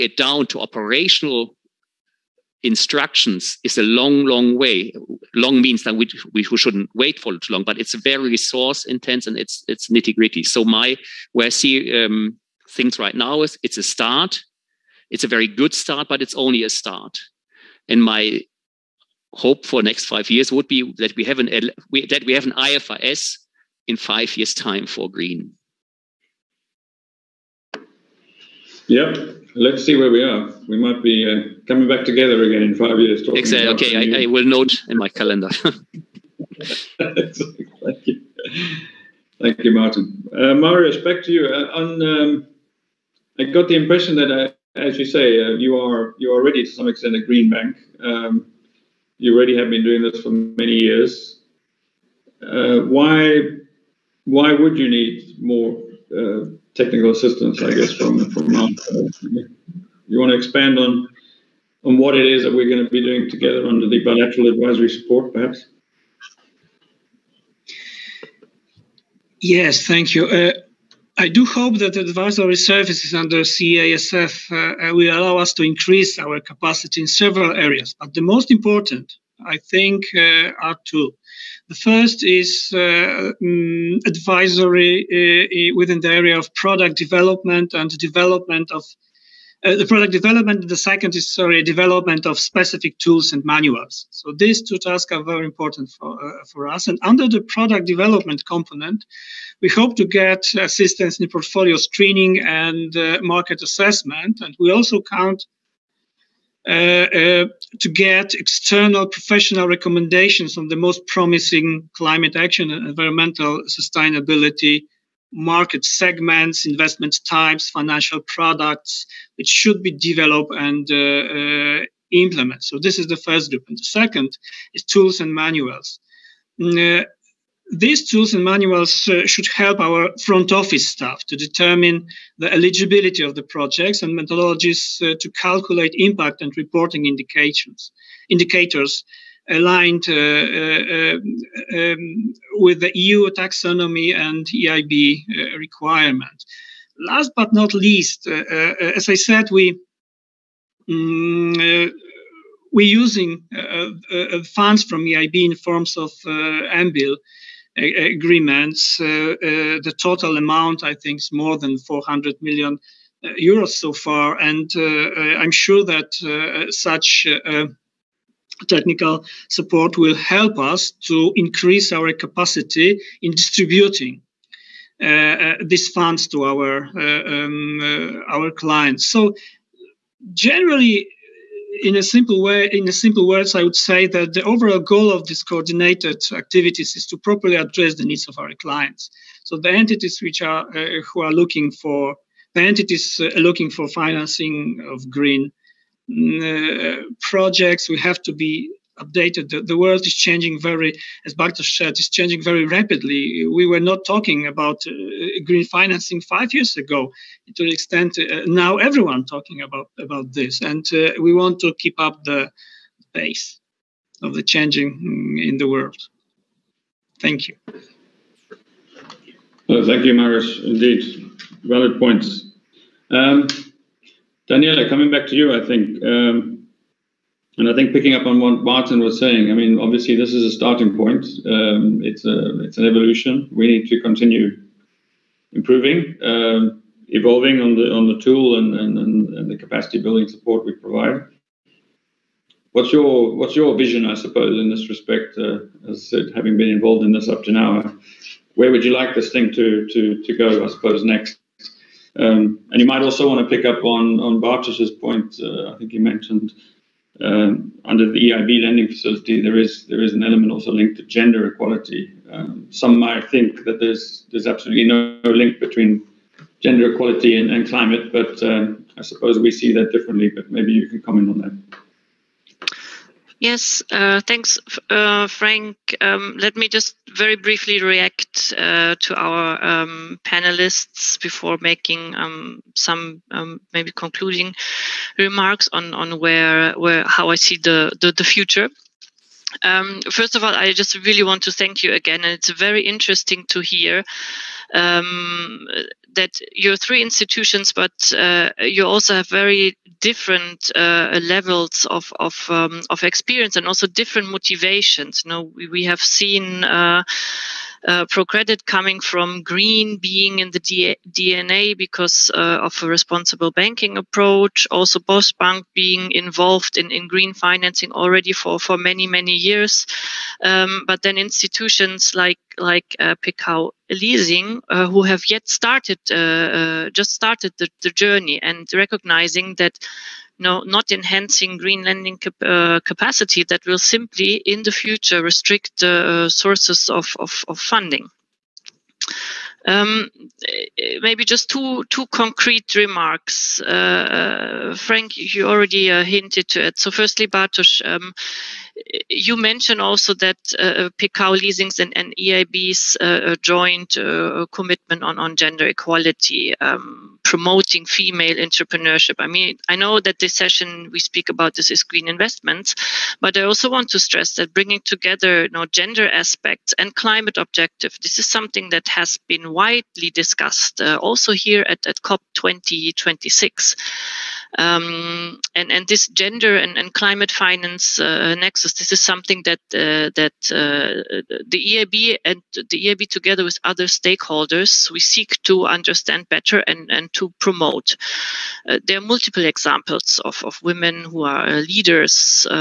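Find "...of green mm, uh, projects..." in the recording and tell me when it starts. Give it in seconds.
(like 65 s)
194 s.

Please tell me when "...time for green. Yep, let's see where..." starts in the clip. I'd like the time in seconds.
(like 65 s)
24 s.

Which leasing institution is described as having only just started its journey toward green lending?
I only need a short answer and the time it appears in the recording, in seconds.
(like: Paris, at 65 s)
Pekao leasing, at 323 s.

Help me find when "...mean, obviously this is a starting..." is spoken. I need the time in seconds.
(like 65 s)
229 s.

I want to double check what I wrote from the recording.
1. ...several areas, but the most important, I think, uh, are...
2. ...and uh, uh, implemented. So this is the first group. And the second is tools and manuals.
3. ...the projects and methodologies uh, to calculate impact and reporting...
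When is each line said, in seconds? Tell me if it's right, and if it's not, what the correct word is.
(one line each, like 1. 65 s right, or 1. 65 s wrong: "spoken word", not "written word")
1. 77 s right
2. 120 s right
3. 133 s right.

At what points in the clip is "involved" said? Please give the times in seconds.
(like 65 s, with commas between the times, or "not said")
246 s, 316 s.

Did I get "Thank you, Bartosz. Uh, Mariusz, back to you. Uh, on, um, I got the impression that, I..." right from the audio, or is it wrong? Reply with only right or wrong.
wrong.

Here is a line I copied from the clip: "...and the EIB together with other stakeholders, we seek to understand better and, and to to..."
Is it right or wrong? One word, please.
right.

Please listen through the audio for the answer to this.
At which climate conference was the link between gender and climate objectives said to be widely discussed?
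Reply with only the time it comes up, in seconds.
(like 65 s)
372 s.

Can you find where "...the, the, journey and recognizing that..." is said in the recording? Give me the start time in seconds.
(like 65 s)
327 s.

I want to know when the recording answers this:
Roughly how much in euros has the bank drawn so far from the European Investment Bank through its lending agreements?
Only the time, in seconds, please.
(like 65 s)
161 s.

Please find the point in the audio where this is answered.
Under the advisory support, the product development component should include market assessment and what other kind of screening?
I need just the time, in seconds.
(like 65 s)
101 s.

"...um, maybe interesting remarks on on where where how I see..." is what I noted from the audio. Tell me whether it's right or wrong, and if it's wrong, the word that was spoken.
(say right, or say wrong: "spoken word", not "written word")
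wrong: "concluding", not "interesting".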